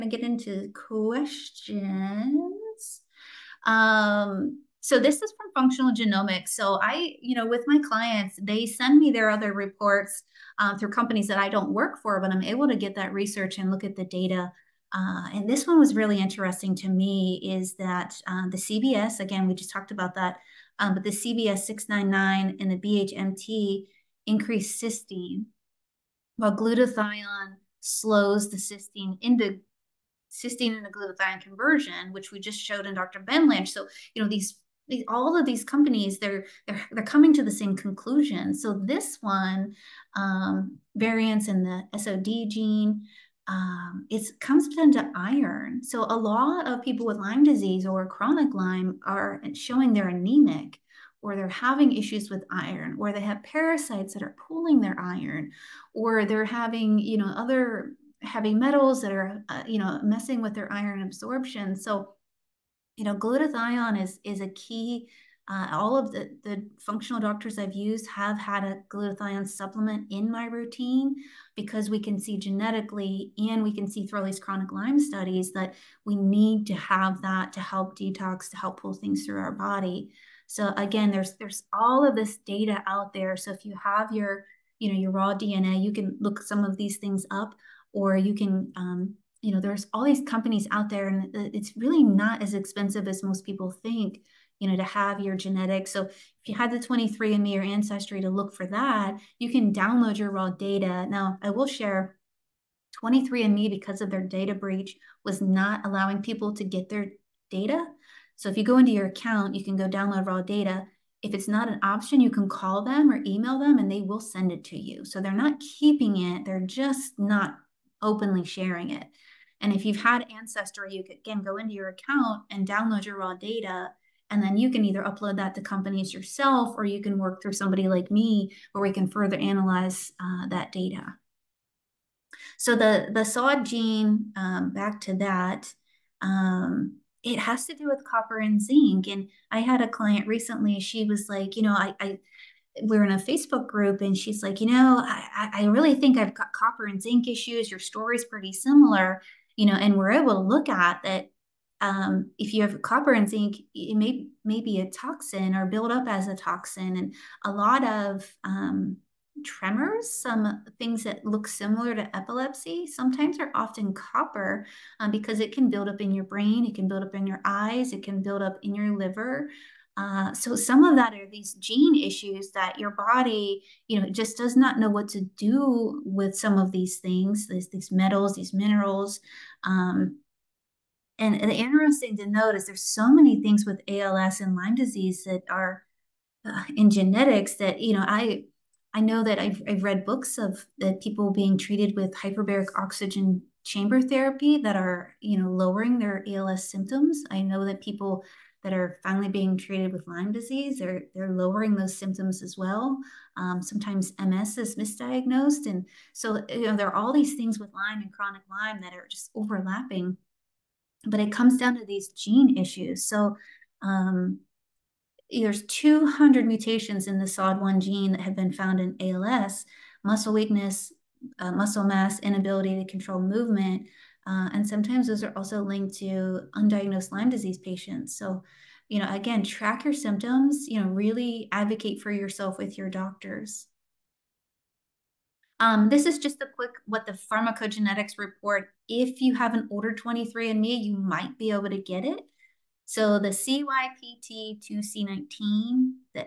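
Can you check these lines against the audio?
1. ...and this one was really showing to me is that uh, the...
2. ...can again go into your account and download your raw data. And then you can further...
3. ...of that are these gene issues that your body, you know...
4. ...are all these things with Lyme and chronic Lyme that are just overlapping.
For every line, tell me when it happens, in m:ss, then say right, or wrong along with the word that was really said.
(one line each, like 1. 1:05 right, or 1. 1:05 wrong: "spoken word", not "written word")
1. 0:15 wrong: "interesting", not "showing"
2. 2:01 wrong: "either", not "further"
3. 2:50 right
4. 3:26 right.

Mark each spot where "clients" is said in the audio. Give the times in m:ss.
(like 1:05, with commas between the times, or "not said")
0:07, 2:19.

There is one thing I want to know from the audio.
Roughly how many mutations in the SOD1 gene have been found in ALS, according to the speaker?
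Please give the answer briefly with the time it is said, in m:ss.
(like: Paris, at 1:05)
200, at 3:35.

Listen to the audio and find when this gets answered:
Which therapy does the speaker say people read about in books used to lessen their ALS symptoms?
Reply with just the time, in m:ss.
3:12.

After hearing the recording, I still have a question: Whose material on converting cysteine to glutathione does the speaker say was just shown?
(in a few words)
Dr. Ben Lynch.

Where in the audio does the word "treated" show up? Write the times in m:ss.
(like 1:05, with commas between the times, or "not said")
3:11, 3:19.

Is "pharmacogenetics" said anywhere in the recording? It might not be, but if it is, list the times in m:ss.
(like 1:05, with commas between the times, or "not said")
3:57.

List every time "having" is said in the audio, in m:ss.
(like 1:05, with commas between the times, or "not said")
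0:51, 0:56.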